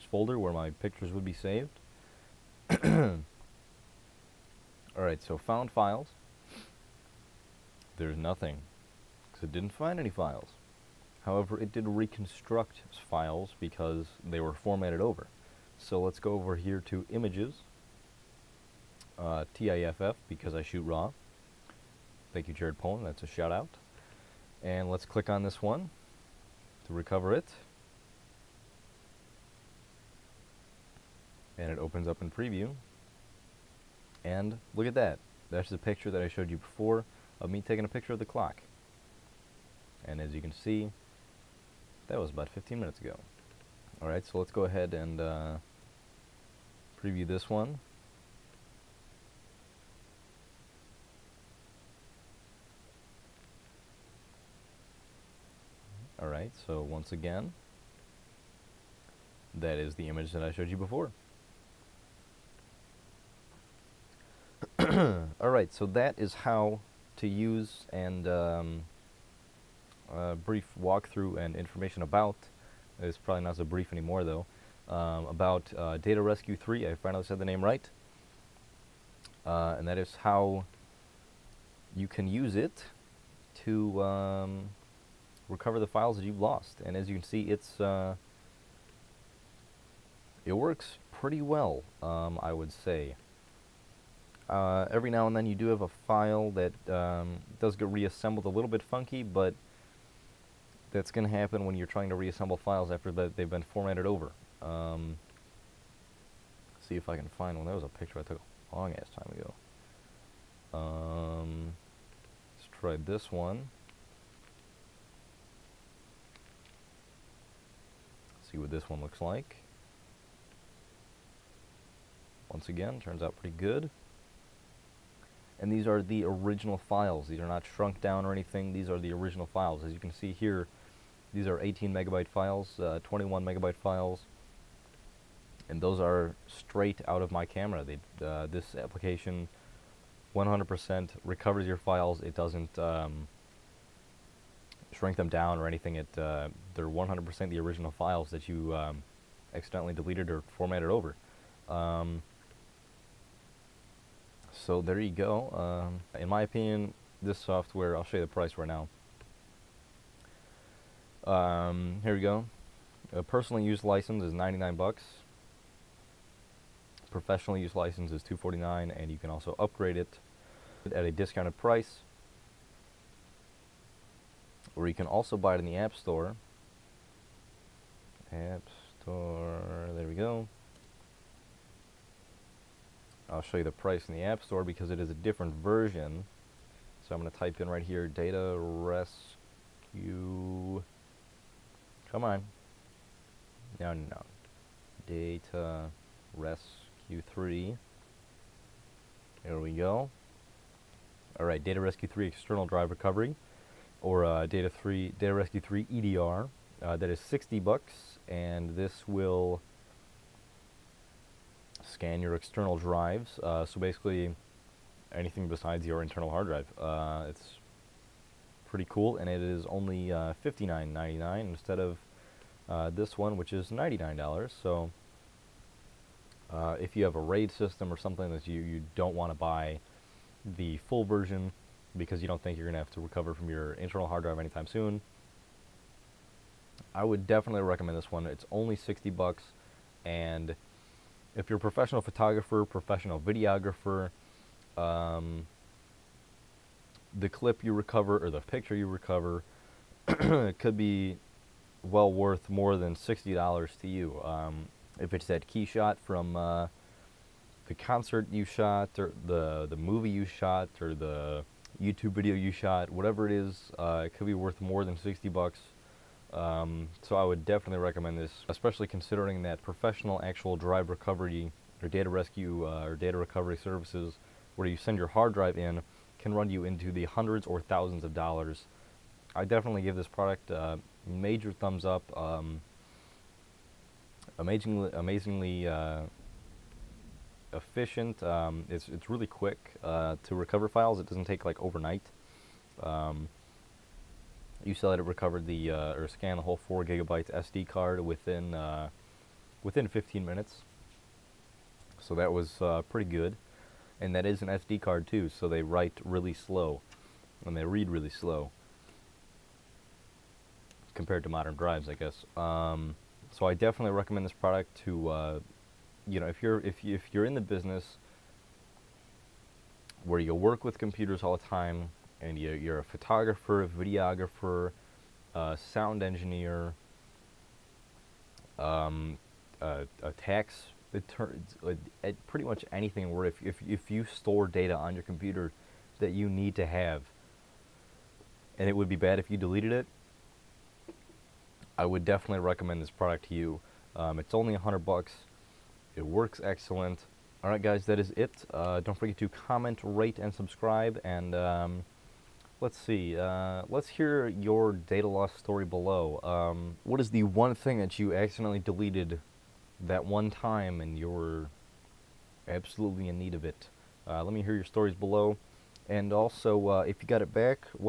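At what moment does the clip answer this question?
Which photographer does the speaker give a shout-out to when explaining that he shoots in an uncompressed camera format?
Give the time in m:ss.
0:22.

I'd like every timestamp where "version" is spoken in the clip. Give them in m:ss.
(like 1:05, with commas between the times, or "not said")
3:05, 3:51.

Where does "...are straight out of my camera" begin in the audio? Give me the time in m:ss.
2:15.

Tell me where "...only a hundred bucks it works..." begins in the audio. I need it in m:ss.
5:44.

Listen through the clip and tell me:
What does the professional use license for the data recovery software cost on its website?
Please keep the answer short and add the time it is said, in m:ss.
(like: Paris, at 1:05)
$249, at 2:48.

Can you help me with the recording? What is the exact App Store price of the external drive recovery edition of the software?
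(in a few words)
$59.99.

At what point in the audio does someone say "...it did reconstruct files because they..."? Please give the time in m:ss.
0:11.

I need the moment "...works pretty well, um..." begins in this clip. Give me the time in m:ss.
1:30.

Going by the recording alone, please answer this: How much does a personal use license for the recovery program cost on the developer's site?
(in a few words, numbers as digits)
$99.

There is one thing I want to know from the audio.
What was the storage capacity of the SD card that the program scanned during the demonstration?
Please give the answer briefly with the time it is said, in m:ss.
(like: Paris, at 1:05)
4 gigabytes, at 4:56.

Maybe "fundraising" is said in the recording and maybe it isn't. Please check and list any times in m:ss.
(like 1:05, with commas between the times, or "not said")
not said.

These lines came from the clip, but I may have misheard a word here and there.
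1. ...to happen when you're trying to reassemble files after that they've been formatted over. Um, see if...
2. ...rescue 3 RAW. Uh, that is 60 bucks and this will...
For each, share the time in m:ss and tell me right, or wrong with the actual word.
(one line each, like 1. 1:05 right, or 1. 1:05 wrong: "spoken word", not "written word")
1. 1:41 right
2. 3:25 wrong: "EDR", not "RAW".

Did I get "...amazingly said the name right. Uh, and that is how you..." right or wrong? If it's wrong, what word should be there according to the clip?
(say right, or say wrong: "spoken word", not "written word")
wrong: "finally", not "amazingly".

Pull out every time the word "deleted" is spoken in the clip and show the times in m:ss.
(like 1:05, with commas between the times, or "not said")
2:29, 5:39, 5:58.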